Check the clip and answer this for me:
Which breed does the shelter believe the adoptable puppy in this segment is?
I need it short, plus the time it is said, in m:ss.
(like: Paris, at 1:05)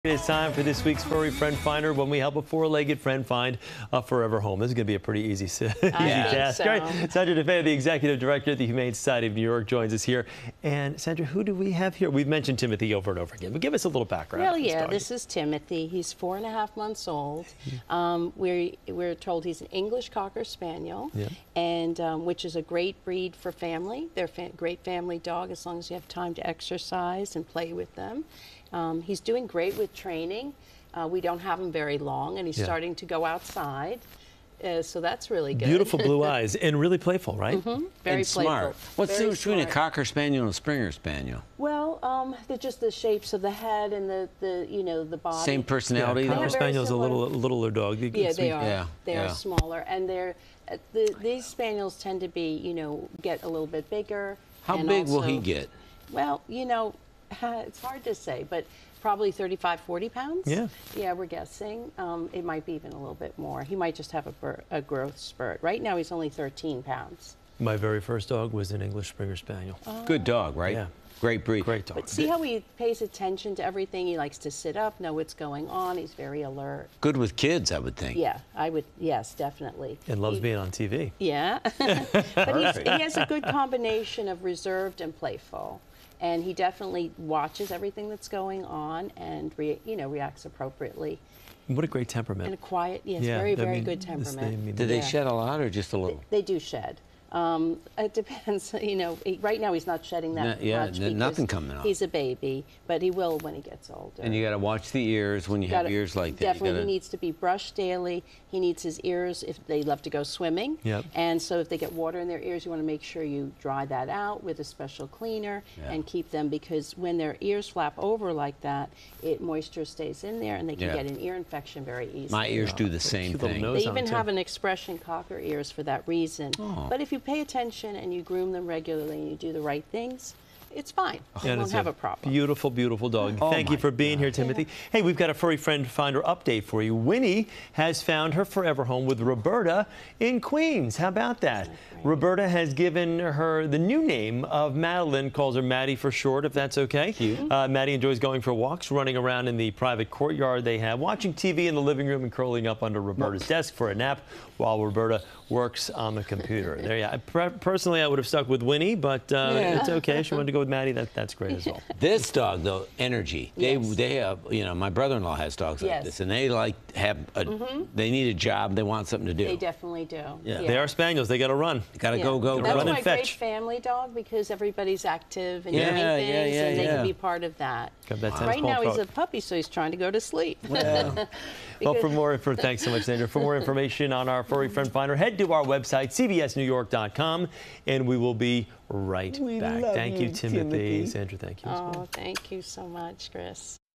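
English Cocker Spaniel, at 0:19.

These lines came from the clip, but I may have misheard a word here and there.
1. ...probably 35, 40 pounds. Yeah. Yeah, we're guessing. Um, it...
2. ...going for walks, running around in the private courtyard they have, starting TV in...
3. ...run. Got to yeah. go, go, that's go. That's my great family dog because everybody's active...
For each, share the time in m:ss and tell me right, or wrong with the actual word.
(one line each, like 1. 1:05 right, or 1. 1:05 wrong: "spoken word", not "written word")
1. 0:59 right
2. 2:28 wrong: "watching", not "starting"
3. 2:51 right.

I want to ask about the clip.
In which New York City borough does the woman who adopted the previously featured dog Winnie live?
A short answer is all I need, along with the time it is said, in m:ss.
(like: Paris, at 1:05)
Queens, at 2:20.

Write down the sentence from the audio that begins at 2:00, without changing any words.
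get an ear infection very easily.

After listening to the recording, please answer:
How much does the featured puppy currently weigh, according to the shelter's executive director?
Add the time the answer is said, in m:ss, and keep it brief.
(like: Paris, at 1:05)
13 pounds, at 1:06.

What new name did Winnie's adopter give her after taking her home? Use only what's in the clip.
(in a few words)
Madeline.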